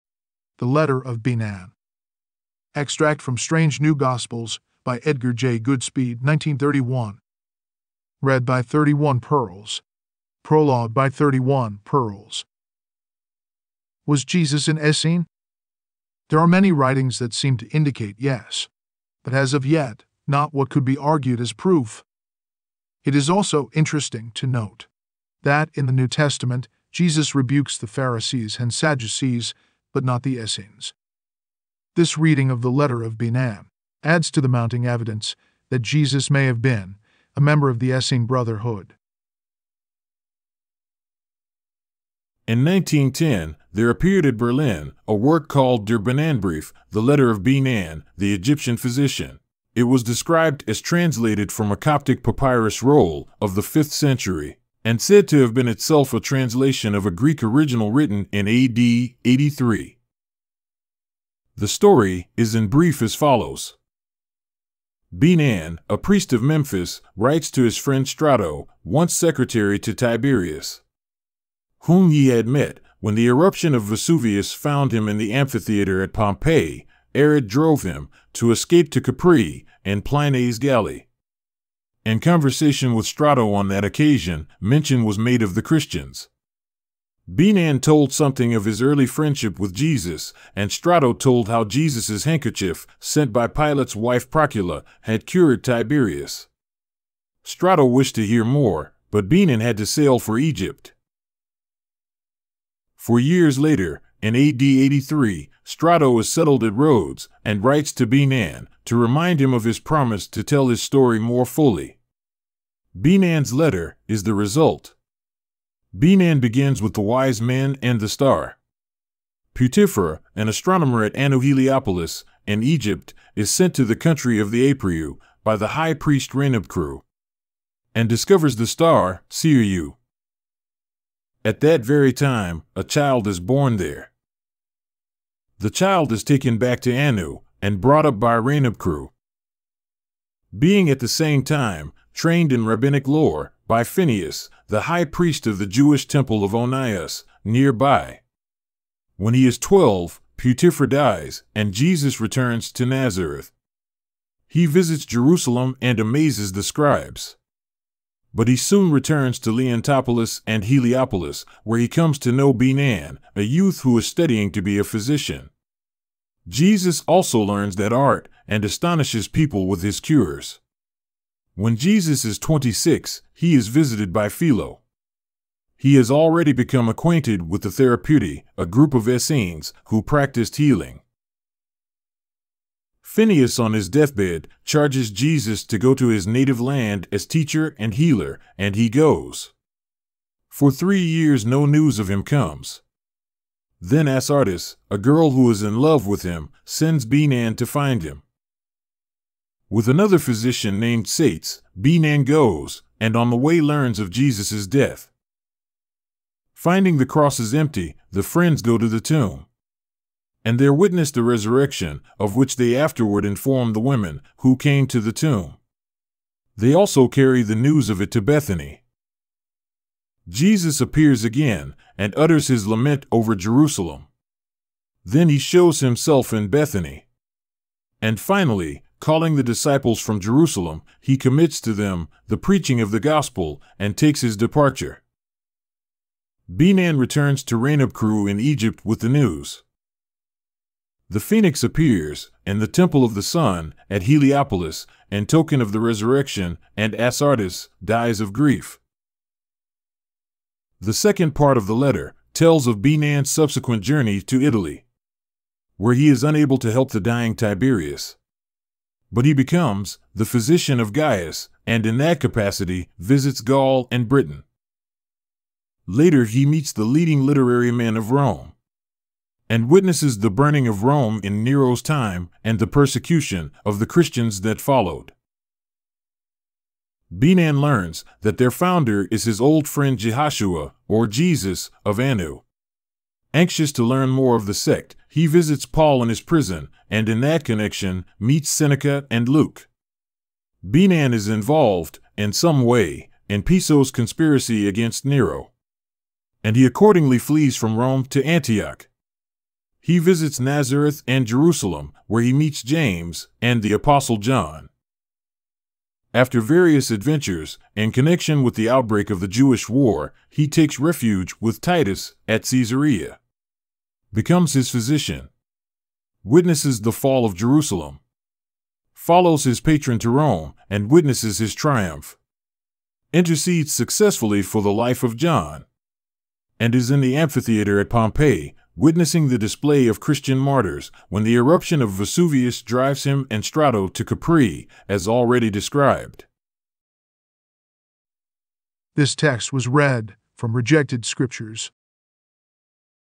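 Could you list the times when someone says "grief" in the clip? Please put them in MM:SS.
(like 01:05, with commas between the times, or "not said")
04:08.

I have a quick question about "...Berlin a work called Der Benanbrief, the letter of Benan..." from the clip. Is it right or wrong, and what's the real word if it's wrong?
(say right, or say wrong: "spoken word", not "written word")
right.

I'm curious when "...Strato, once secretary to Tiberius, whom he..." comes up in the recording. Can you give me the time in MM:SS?
01:08.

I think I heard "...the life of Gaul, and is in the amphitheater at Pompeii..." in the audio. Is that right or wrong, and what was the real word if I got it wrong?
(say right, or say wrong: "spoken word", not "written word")
wrong: "John", not "Gaul".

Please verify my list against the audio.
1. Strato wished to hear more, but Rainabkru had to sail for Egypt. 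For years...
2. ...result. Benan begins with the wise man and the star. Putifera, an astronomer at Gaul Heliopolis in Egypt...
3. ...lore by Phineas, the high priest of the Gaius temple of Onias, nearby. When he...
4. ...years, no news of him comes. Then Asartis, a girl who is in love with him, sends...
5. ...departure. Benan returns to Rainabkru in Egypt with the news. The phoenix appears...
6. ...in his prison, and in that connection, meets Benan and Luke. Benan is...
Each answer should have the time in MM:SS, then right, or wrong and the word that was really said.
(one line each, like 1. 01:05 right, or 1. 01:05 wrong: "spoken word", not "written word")
1. 01:37 wrong: "Benan", not "Rainabkru"
2. 01:54 wrong: "Anu", not "Gaul"
3. 02:23 wrong: "Jewish", not "Gaius"
4. 03:11 right
5. 03:54 right
6. 04:46 wrong: "Seneca", not "Benan".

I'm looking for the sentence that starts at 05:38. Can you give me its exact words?
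This text was read from rejected scriptures.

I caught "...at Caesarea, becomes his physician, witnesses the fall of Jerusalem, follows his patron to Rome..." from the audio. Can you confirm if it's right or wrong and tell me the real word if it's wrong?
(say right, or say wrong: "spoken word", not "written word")
right.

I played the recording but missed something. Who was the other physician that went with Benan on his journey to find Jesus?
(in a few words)
Sates.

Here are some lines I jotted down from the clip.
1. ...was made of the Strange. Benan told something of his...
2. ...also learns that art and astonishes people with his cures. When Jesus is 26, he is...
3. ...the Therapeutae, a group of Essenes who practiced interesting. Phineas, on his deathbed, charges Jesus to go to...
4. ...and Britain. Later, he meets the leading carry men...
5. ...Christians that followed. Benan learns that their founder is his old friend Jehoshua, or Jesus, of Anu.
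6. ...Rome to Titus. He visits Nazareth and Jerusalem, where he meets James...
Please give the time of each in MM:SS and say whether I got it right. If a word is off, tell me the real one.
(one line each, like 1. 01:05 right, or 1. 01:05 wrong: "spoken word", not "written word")
1. 01:25 wrong: "Christians", not "Strange"
2. 02:47 right
3. 02:57 wrong: "healing", not "interesting"
4. 04:23 wrong: "literary", not "carry"
5. 04:33 right
6. 04:57 wrong: "Antioch", not "Titus".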